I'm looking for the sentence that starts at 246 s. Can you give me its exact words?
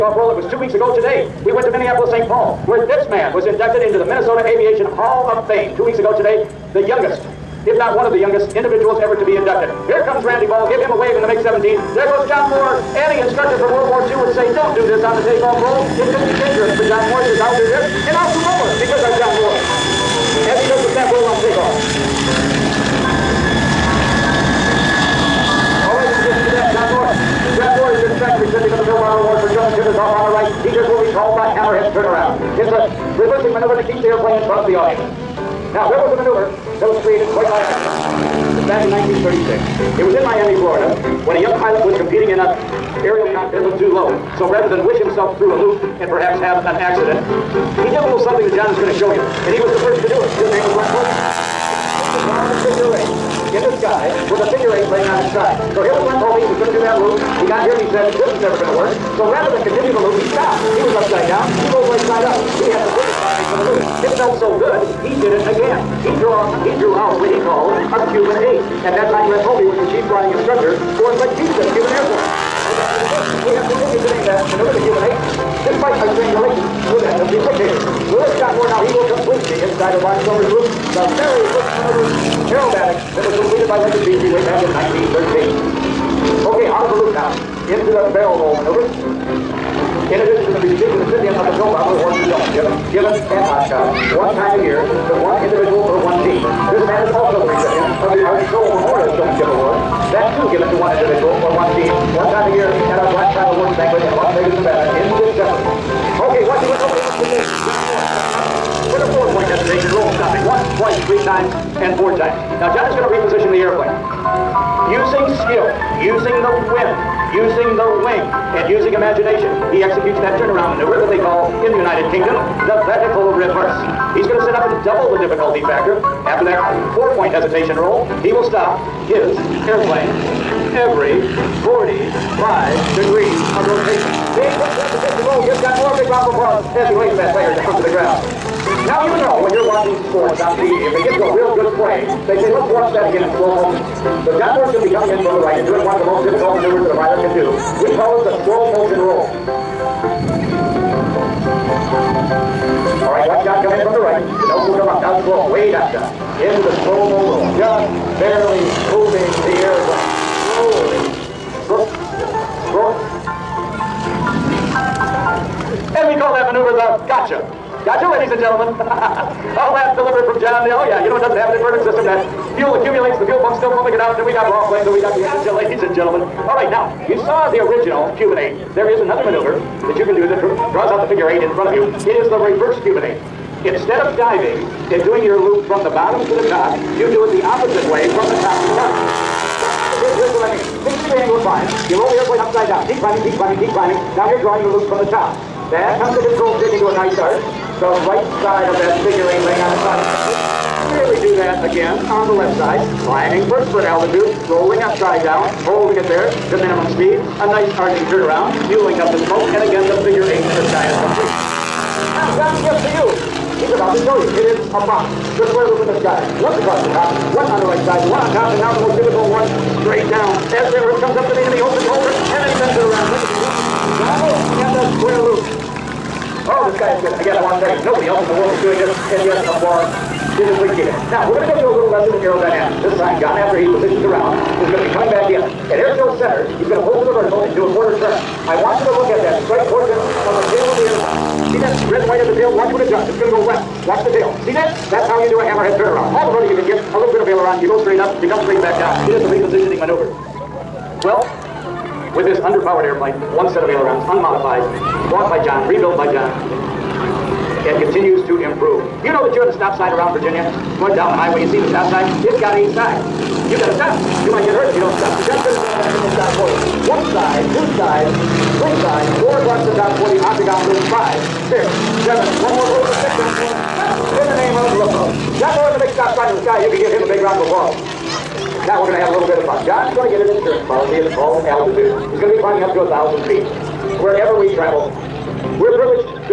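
All the rotor you can get, a little bit of aileron.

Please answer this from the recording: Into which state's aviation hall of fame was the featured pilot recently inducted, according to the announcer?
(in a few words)
Minnesota.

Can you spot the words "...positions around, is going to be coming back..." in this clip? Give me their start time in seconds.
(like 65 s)
233 s.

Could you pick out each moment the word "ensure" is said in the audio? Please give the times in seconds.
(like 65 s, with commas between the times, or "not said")
not said.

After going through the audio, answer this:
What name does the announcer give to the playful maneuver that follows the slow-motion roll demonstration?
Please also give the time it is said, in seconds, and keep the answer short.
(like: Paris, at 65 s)
The gotcha, at 166 s.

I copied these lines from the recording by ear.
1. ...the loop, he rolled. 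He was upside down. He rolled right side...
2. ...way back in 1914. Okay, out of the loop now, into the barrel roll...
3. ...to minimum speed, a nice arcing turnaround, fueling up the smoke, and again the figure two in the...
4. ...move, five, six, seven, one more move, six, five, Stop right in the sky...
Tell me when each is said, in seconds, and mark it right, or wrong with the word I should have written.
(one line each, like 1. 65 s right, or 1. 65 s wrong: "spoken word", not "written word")
1. 59 s wrong: "stopped", not "rolled"
2. 84 s wrong: "1913", not "1914"
3. 206 s wrong: "eight", not "two"
4. 270 s wrong: "seven", not "five".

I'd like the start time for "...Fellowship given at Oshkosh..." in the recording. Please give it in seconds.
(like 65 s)
92 s.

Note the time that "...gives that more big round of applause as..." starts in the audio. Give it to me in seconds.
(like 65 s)
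135 s.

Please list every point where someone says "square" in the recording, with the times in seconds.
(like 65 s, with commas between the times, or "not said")
215 s, 224 s.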